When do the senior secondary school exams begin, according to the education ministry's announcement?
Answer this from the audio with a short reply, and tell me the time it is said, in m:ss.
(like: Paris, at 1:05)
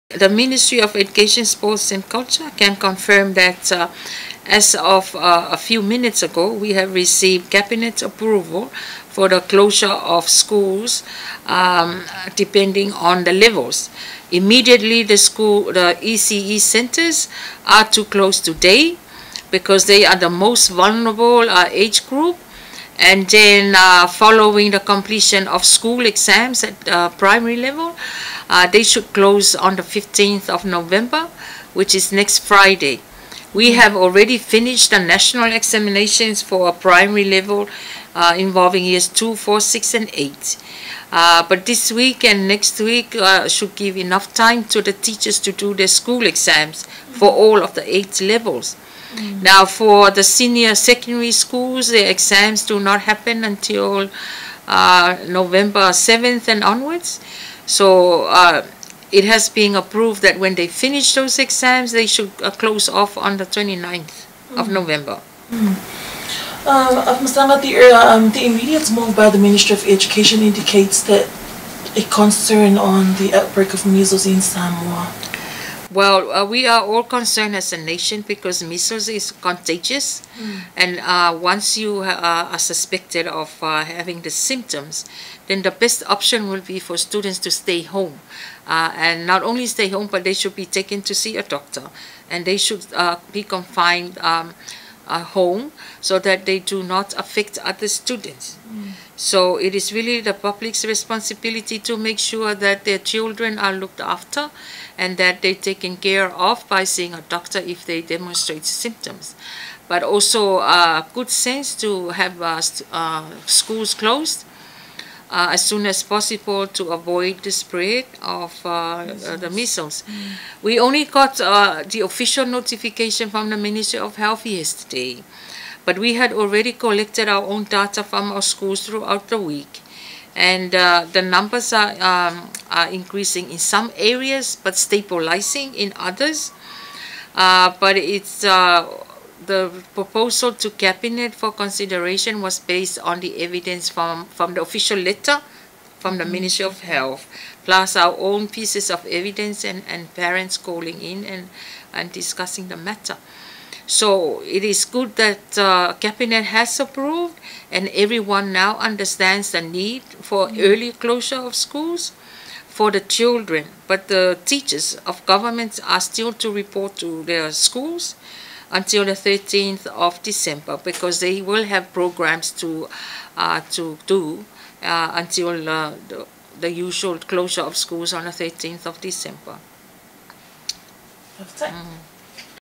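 November 7, at 0:55.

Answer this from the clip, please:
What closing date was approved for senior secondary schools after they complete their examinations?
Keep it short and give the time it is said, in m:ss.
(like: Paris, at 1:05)
29 November, at 1:03.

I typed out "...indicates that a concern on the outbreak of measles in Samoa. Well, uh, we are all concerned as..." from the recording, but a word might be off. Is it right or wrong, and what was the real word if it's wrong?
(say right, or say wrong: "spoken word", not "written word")
right.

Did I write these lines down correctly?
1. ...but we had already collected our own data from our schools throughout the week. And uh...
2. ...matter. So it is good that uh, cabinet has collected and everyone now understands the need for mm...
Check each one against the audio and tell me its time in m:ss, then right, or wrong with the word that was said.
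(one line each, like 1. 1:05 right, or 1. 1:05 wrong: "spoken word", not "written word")
1. 2:05 right
2. 2:32 wrong: "approved", not "collected".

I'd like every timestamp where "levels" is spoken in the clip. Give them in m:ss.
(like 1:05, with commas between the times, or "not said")
0:13, 0:27, 0:37, 0:48.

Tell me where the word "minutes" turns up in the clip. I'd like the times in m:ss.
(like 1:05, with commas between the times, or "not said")
0:05.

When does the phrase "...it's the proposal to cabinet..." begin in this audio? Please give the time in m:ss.
2:17.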